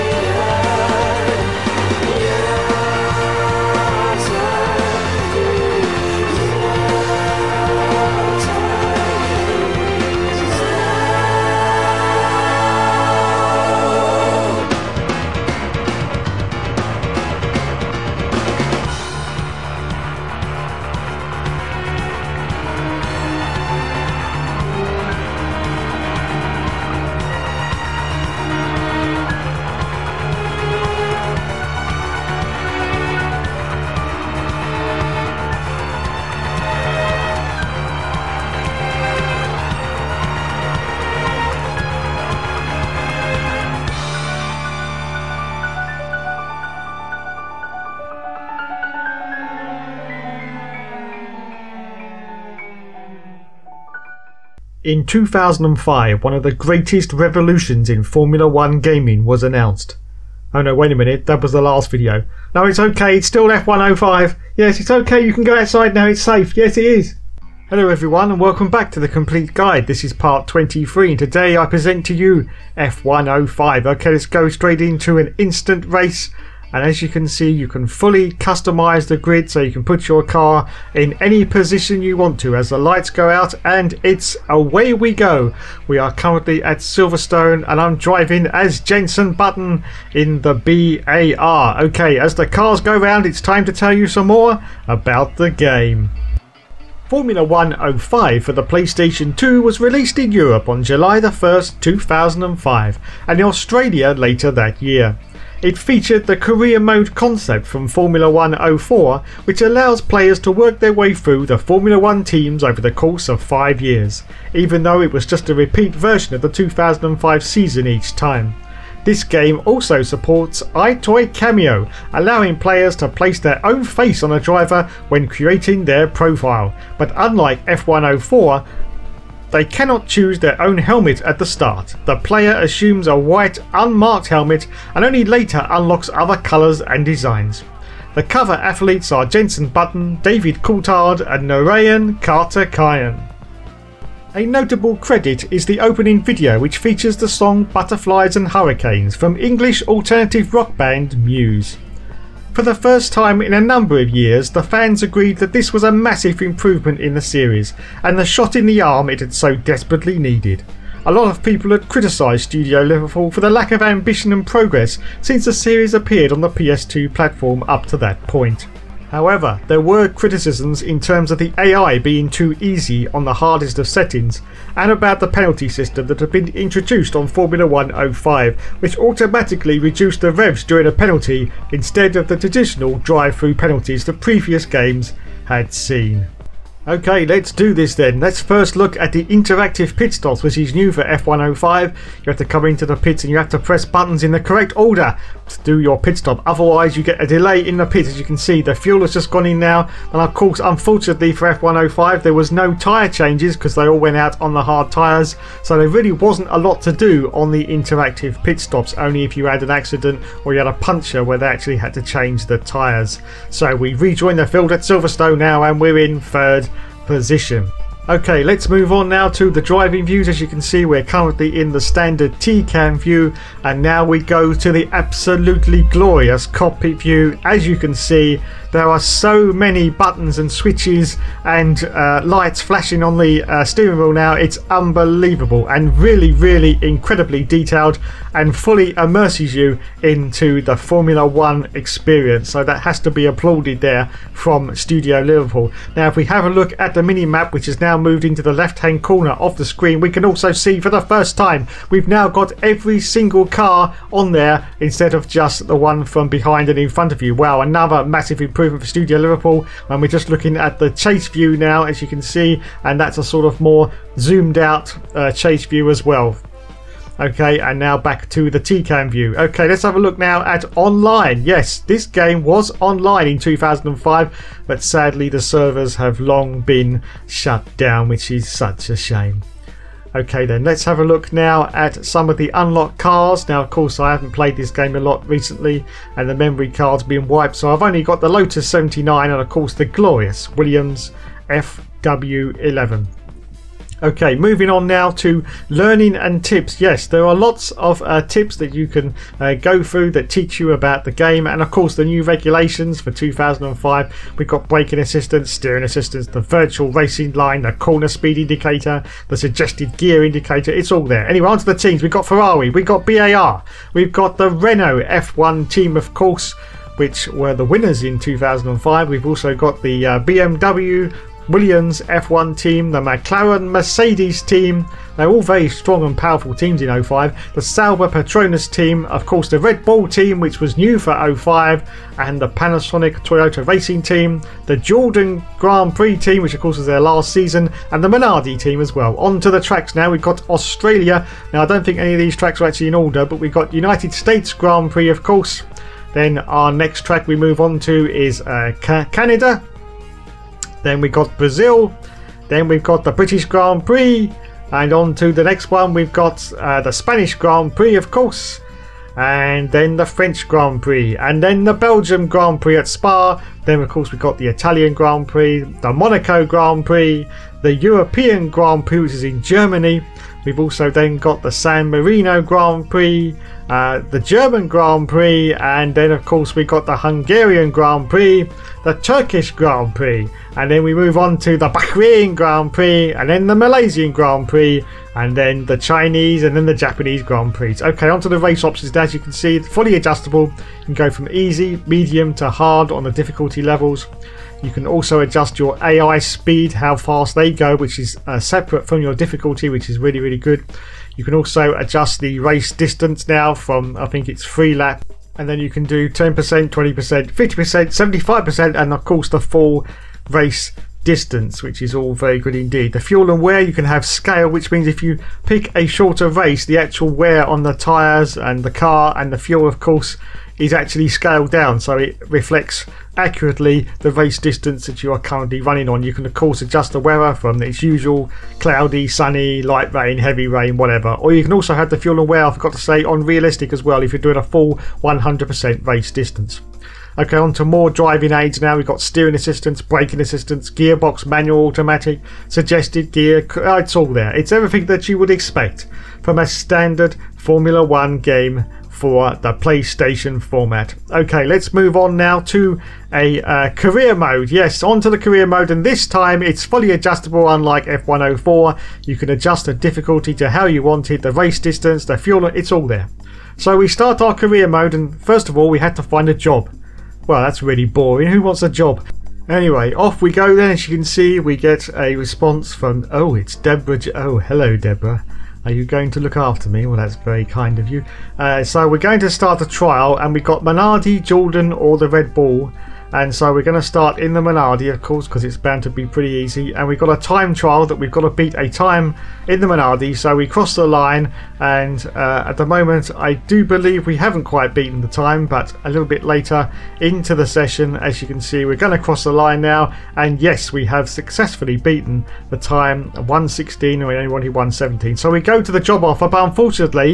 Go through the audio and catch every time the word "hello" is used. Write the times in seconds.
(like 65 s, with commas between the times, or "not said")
67 s, 474 s.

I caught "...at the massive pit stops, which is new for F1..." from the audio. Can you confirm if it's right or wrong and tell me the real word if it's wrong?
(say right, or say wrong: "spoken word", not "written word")
wrong: "interactive", not "massive".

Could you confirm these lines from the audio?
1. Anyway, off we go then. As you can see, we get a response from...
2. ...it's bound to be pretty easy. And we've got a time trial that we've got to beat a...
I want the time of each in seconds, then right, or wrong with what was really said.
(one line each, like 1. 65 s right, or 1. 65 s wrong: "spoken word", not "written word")
1. 469 s right
2. 485 s right.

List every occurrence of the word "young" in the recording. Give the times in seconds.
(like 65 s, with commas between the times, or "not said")
not said.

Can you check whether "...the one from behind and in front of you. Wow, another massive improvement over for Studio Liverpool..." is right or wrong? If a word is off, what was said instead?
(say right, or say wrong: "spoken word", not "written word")
right.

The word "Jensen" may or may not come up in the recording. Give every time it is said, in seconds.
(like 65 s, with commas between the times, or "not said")
88 s, 139 s.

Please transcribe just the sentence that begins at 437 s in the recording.
Okay, on to more driving aids now.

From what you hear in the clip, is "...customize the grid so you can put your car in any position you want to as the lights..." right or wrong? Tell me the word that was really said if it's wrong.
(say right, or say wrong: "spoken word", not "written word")
right.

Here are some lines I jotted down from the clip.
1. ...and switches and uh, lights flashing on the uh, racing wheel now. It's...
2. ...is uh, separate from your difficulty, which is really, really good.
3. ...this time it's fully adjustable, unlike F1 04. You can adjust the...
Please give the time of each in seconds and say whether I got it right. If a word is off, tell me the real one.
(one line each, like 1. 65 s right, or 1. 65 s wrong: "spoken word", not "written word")
1. 230 s wrong: "steering", not "racing"
2. 397 s right
3. 455 s right.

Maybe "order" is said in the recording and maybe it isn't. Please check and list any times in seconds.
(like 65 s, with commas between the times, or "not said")
194 s, 342 s.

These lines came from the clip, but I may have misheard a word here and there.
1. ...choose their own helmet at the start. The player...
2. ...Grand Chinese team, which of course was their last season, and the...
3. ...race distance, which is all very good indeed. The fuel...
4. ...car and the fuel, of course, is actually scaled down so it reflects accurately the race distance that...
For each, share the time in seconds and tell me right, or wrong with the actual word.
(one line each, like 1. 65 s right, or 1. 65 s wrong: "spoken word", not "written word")
1. 130 s right
2. 335 s wrong: "Prix", not "Chinese"
3. 410 s right
4. 418 s right.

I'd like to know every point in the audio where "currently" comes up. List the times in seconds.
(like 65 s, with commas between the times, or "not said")
86 s, 221 s, 425 s.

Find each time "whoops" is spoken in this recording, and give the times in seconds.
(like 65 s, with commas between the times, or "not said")
not said.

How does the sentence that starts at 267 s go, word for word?
Okay, and now back to the TCAM view.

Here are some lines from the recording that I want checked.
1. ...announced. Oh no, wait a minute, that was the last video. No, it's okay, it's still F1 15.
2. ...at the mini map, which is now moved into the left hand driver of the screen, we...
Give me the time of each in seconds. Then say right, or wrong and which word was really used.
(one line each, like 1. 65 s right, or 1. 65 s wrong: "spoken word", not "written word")
1. 59 s wrong: "05", not "15"
2. 246 s wrong: "corner", not "driver".